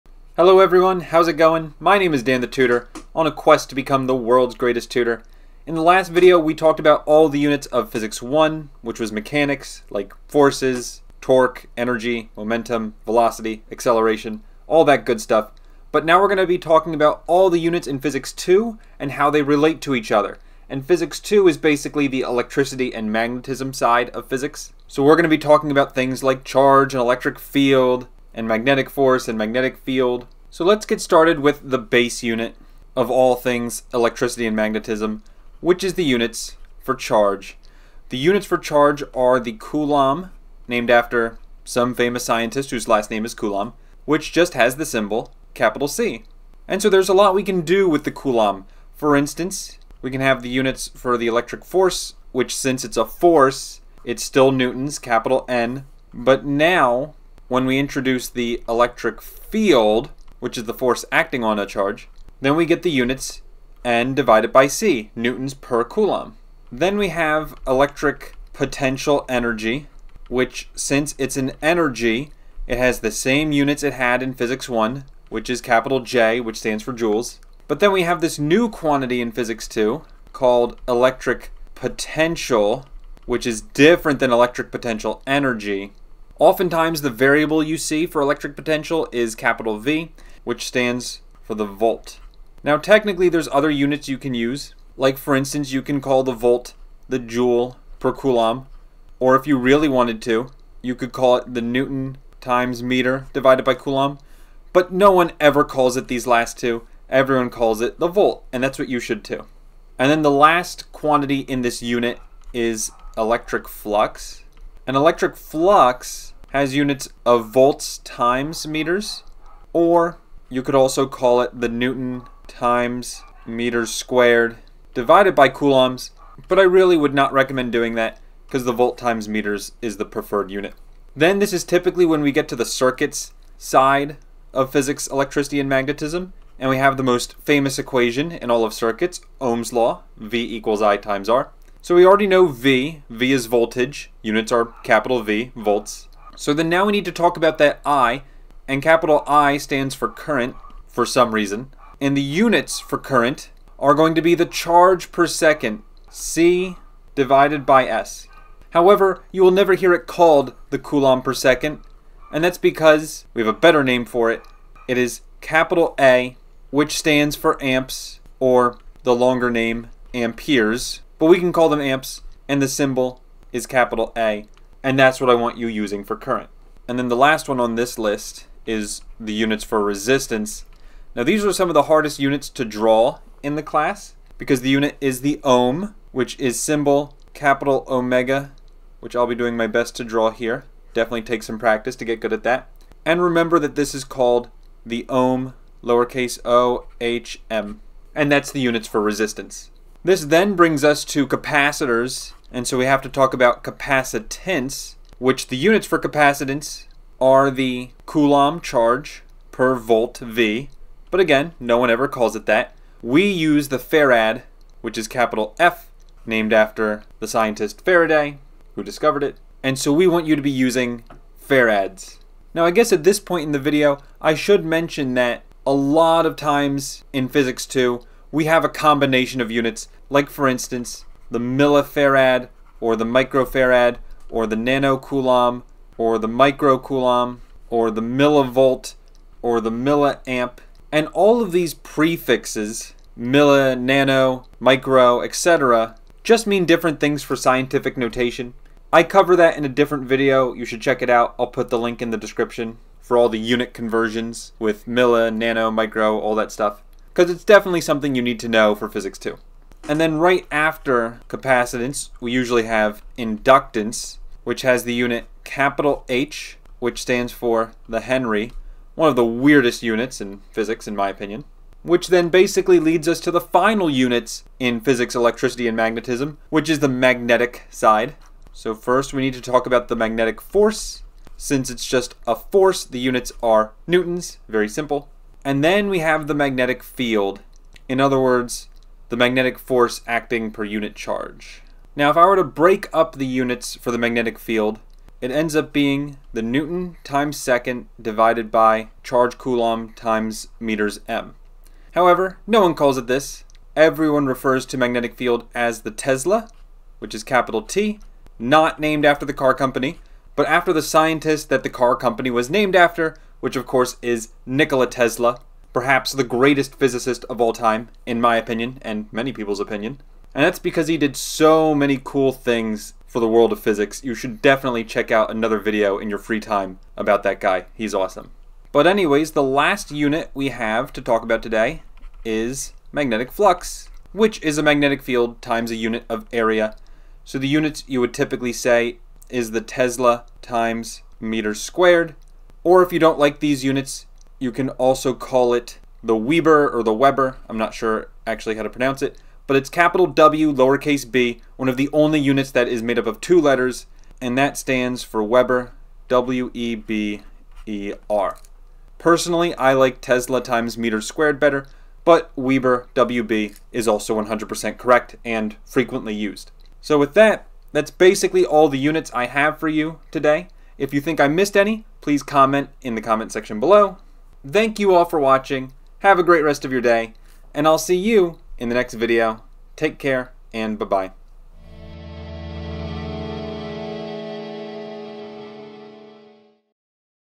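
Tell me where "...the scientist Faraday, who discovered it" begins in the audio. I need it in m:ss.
3:37.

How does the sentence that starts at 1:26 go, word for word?
Oftentimes, the variable you see for electric potential is capital V, which stands for the volt.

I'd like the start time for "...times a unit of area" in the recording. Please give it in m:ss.
5:35.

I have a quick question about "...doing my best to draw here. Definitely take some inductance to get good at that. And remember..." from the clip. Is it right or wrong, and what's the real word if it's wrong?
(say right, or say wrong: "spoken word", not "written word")
wrong: "practice", not "inductance".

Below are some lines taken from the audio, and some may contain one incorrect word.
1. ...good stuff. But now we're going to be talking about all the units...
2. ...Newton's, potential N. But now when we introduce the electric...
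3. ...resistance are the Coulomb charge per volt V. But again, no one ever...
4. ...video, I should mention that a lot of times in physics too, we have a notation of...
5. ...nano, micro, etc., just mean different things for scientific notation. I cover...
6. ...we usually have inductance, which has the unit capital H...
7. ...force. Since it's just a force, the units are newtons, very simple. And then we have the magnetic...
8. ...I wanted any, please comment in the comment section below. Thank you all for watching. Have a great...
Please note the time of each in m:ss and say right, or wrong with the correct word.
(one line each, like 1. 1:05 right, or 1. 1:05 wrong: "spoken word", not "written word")
1. 0:15 right
2. 0:54 wrong: "capital", not "potential"
3. 3:25 wrong: "capacitance", not "resistance"
4. 3:43 wrong: "combination", not "notation"
5. 4:03 right
6. 4:22 right
7. 4:40 right
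8. 6:11 wrong: "missed", not "wanted".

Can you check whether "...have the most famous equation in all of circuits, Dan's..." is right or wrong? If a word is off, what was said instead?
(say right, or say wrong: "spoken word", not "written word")
wrong: "Ohm", not "Dan".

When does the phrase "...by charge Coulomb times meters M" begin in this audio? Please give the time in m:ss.
4:58.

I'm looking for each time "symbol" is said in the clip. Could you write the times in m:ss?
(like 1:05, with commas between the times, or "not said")
0:44, 2:52, 3:06.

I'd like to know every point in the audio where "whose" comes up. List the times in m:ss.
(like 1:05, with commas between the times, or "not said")
0:42.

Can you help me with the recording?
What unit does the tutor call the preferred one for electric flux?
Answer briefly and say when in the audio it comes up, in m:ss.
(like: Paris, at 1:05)
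volts times meters, at 1:57.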